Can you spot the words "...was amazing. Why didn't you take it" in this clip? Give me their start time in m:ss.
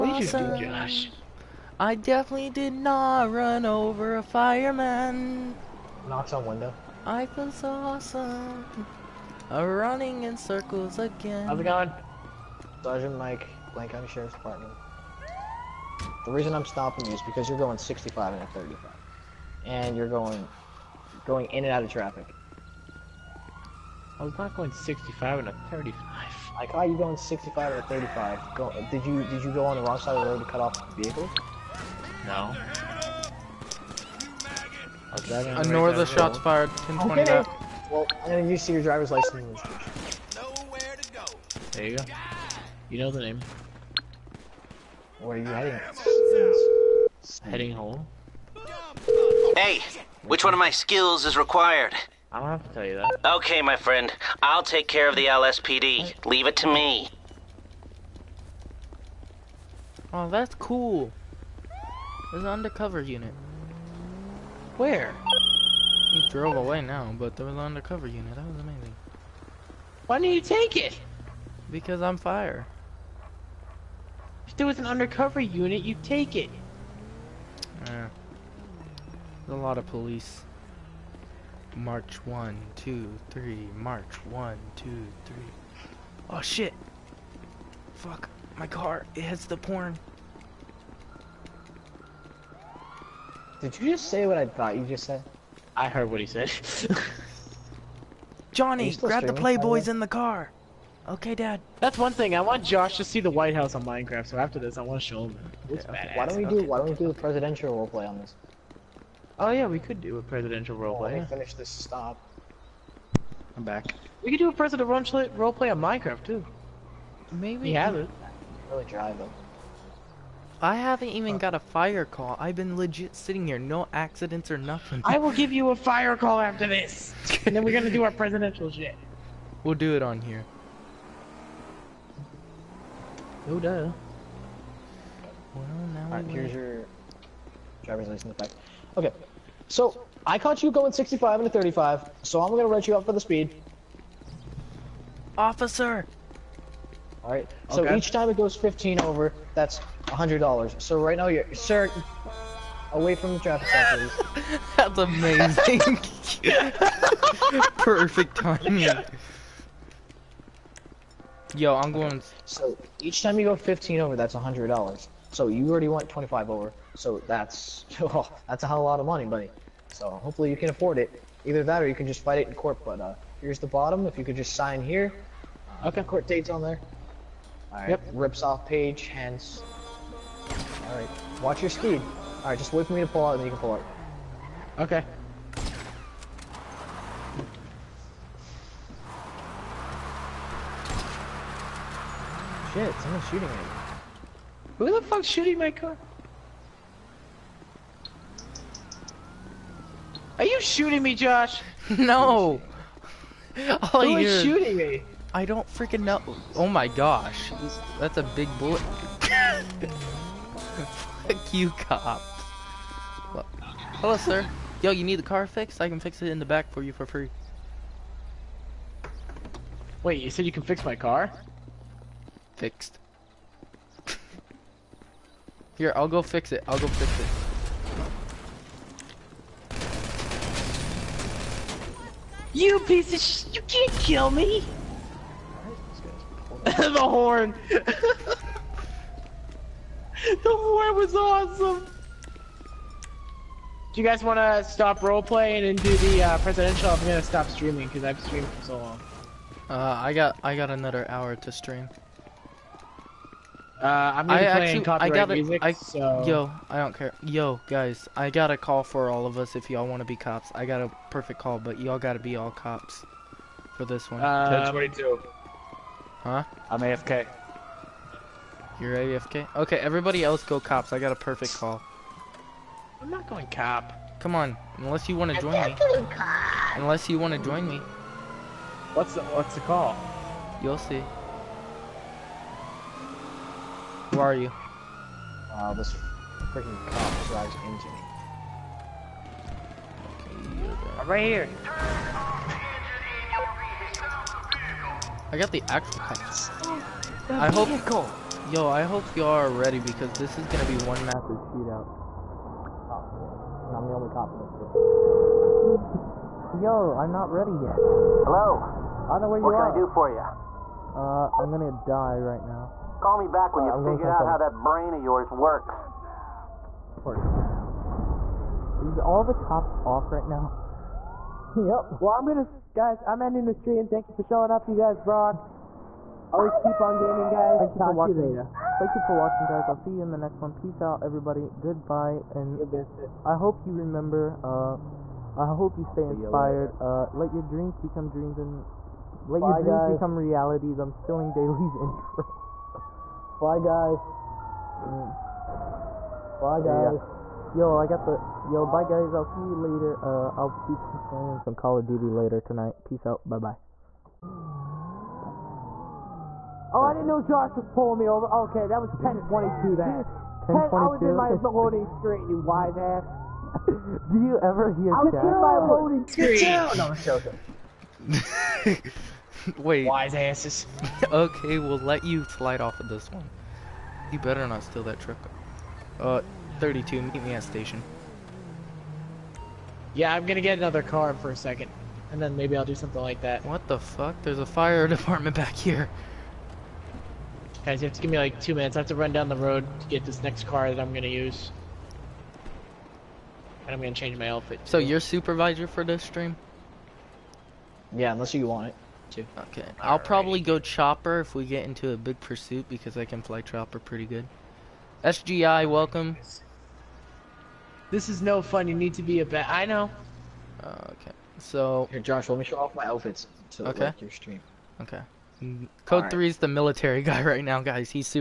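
1:08.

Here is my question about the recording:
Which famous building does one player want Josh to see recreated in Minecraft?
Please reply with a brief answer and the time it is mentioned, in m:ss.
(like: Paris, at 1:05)
The White House, at 1:43.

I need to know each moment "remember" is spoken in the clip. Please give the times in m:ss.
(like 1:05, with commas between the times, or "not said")
5:33.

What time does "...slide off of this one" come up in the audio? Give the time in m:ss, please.
6:12.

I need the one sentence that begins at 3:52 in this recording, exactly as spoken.
You piece of sh- You can't kill me!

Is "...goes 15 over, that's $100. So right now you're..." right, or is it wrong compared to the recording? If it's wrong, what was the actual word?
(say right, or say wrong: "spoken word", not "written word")
right.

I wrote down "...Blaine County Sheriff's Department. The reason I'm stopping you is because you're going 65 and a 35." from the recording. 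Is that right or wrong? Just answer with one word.
right.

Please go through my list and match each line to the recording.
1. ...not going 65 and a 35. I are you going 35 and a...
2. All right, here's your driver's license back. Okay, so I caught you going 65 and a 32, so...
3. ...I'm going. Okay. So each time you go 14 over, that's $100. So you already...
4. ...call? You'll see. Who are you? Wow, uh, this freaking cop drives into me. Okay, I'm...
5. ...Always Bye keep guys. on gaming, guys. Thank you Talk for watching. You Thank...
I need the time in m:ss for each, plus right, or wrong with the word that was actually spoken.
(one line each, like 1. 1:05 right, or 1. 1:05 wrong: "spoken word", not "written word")
1. 0:24 wrong: "65", not "35"
2. 2:16 wrong: "35", not "32"
3. 2:41 wrong: "15", not "14"
4. 4:39 right
5. 5:26 right.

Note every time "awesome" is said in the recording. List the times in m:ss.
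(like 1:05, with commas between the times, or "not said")
0:07, 4:01.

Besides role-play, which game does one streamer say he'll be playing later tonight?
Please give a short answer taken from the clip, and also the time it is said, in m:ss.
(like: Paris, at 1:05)
Call of Duty, at 5:51.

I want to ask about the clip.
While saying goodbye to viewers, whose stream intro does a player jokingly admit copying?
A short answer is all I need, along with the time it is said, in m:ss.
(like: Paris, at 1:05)
Daly's, at 5:41.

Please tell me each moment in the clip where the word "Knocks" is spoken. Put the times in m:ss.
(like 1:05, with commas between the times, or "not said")
0:06.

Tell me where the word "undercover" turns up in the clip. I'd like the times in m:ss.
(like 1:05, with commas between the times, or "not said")
1:02, 1:07, 1:14.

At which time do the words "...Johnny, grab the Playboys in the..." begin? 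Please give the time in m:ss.
1:38.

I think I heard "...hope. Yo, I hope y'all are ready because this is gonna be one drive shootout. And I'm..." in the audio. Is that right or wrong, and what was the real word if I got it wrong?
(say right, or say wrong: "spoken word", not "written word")
wrong: "massive", not "drive".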